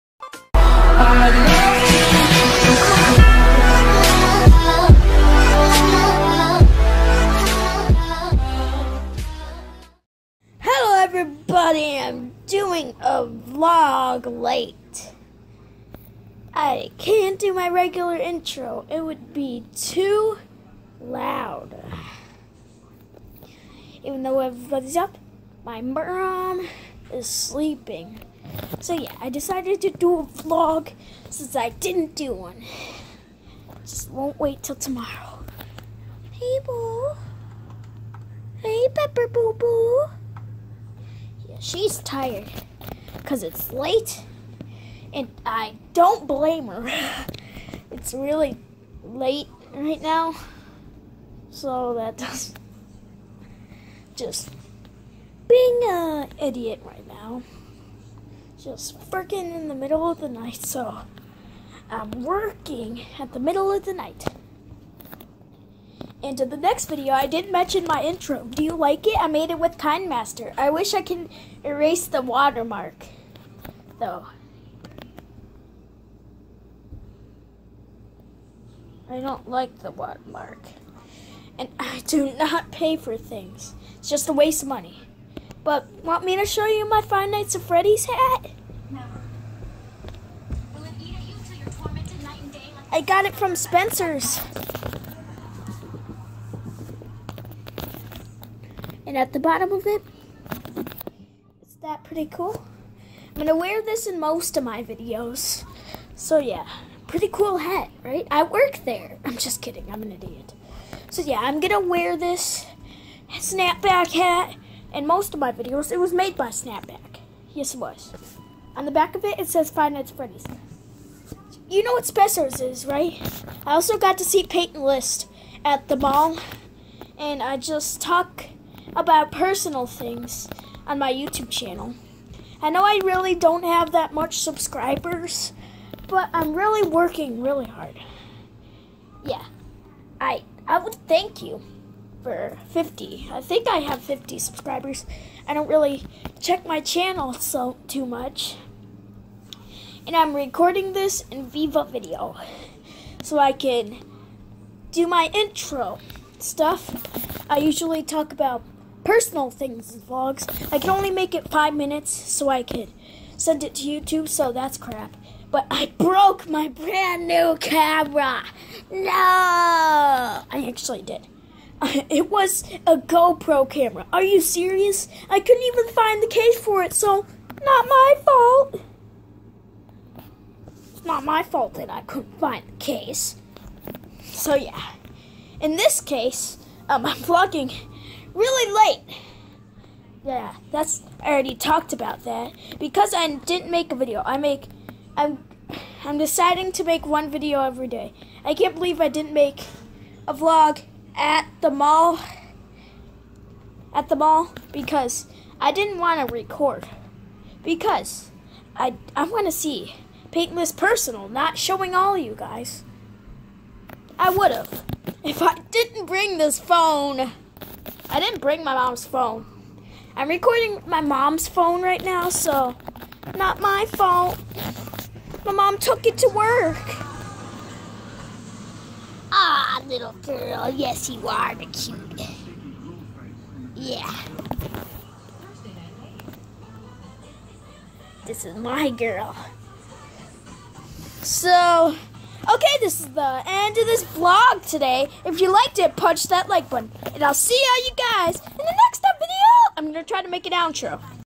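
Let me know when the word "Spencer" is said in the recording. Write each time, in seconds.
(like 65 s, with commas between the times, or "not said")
93 s, 122 s.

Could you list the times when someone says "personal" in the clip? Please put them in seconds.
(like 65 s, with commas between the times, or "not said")
129 s, 159 s, 210 s.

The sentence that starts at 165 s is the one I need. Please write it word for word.
But I broke my brand new camera.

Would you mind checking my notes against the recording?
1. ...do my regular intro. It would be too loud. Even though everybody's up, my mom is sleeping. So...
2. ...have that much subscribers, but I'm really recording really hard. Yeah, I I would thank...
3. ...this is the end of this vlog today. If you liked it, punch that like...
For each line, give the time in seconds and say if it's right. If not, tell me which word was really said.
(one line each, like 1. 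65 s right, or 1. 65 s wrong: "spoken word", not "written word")
1. 17 s right
2. 133 s wrong: "working", not "recording"
3. 242 s right.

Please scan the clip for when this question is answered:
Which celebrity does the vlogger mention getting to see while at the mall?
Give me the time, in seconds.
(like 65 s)
124 s.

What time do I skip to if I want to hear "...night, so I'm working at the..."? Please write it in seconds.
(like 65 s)
60 s.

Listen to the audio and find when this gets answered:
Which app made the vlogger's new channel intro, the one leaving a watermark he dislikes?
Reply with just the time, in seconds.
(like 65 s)
69 s.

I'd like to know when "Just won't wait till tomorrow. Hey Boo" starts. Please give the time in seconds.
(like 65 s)
33 s.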